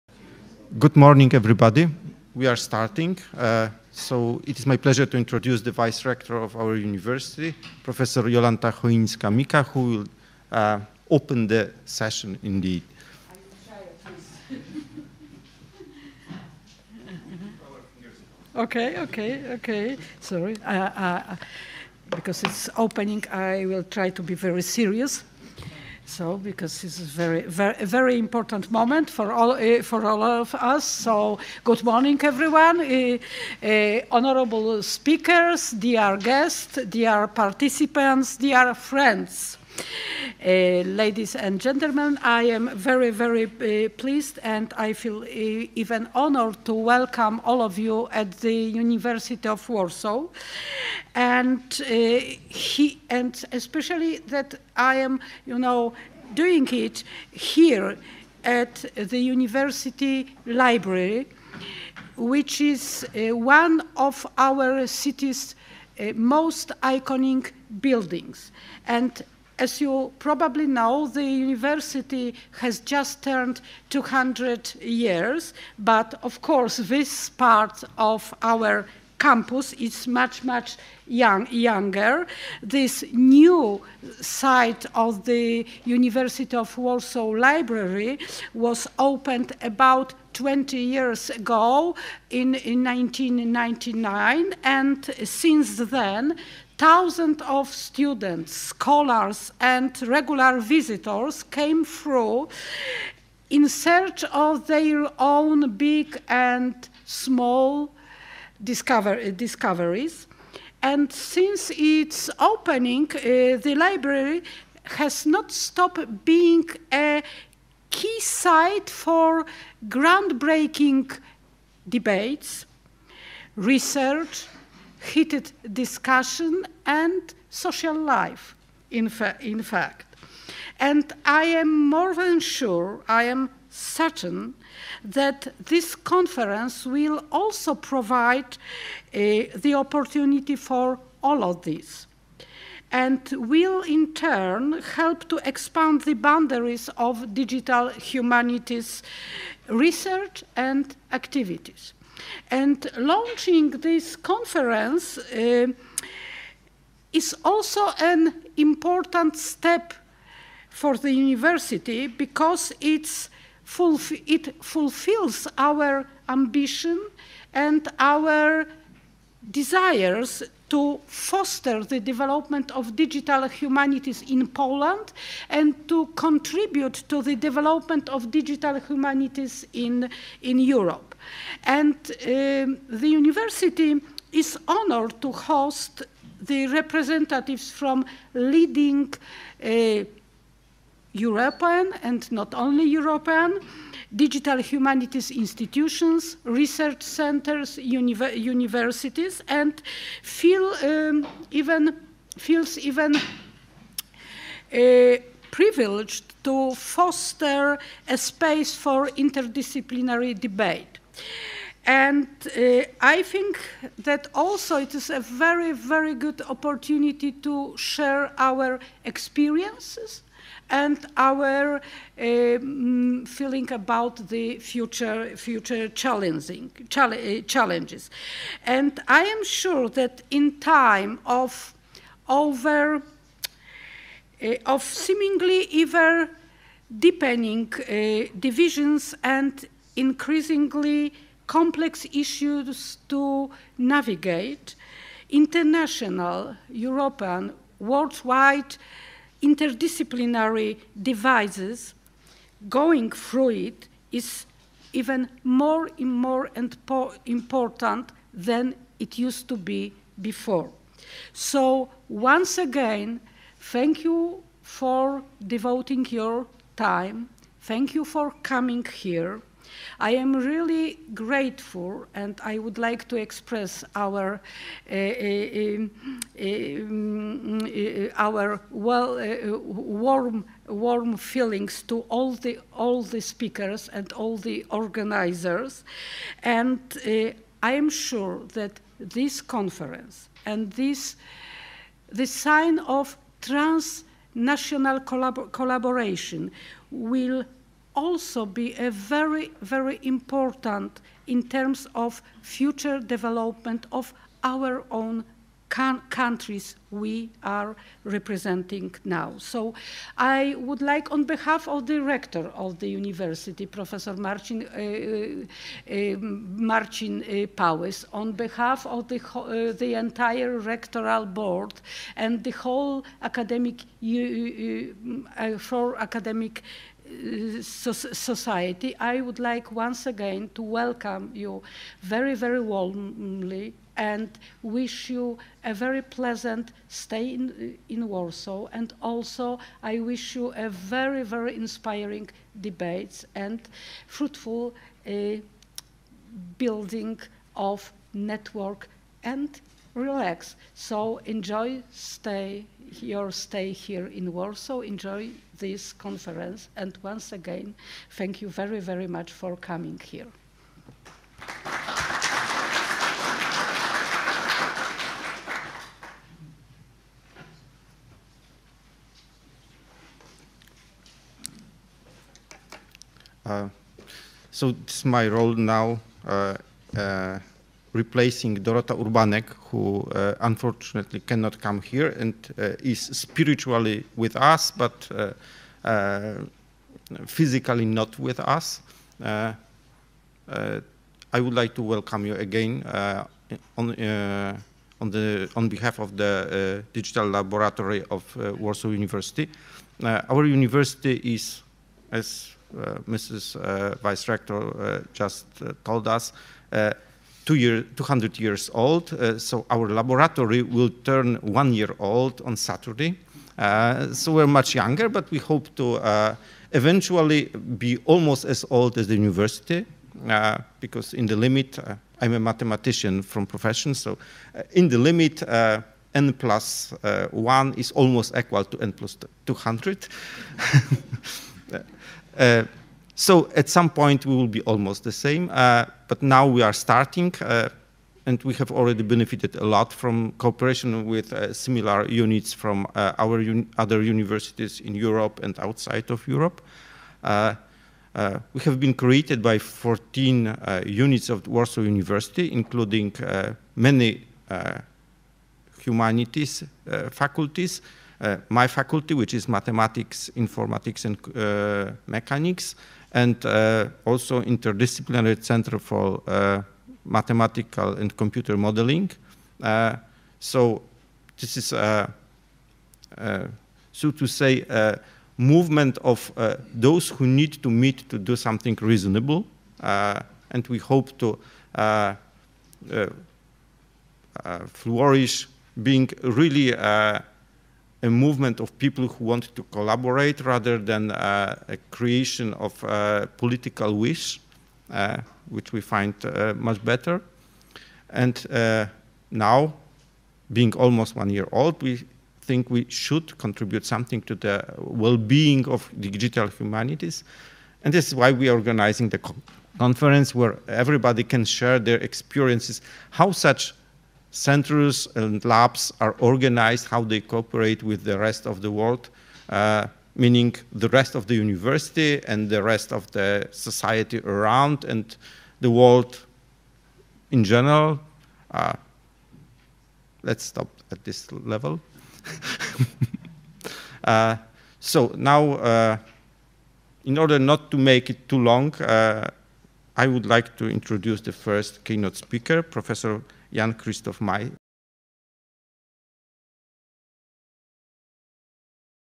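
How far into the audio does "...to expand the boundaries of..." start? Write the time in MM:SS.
02:25.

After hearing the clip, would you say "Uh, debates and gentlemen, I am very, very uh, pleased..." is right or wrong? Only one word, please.
wrong.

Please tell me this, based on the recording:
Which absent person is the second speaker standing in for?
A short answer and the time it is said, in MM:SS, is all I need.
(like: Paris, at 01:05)
Dorota Urbanek, at 06:18.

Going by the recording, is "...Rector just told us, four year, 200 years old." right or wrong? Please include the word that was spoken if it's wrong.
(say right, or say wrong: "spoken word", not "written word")
wrong: "two", not "four".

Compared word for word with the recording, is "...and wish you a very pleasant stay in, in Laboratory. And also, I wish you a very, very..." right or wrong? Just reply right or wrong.
wrong.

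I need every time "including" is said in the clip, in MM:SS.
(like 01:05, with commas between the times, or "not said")
07:32.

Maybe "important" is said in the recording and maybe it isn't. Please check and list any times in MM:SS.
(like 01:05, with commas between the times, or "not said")
00:28, 02:38, 04:17, 05:00.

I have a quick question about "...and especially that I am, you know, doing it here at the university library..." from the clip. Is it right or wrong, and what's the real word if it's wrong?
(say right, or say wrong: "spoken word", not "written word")
right.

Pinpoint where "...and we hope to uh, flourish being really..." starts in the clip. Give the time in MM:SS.
08:00.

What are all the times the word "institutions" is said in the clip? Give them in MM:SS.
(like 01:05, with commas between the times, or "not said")
03:15.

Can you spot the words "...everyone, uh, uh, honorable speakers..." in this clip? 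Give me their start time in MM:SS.
00:32.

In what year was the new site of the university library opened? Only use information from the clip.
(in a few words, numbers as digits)
1999.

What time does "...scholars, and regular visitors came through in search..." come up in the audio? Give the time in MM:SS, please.
01:38.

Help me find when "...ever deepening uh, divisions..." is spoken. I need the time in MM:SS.
03:55.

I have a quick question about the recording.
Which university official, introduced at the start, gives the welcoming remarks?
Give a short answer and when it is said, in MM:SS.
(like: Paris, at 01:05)
Jolanta Choińska-Mika, at 00:08.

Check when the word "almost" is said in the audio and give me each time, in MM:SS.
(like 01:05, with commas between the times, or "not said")
06:58, 07:07, 07:14, 08:20.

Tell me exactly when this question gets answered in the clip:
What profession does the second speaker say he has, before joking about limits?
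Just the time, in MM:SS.
07:02.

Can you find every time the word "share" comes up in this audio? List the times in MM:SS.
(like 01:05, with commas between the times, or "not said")
03:37, 08:31.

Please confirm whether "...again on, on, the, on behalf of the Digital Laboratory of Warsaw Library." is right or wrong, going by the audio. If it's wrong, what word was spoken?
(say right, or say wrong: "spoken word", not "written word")
wrong: "University", not "Library".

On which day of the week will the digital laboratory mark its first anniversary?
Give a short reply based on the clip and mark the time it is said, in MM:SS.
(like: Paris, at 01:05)
Saturday, at 06:52.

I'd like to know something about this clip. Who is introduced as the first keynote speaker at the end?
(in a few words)
Jan Christoph Mai.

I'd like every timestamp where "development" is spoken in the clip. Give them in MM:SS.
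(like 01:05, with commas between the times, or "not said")
02:51, 02:57, 05:02.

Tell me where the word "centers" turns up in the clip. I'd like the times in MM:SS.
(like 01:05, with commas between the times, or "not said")
03:17, 07:45, 08:34.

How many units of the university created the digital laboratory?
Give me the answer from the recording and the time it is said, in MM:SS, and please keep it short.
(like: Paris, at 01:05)
14, at 07:29.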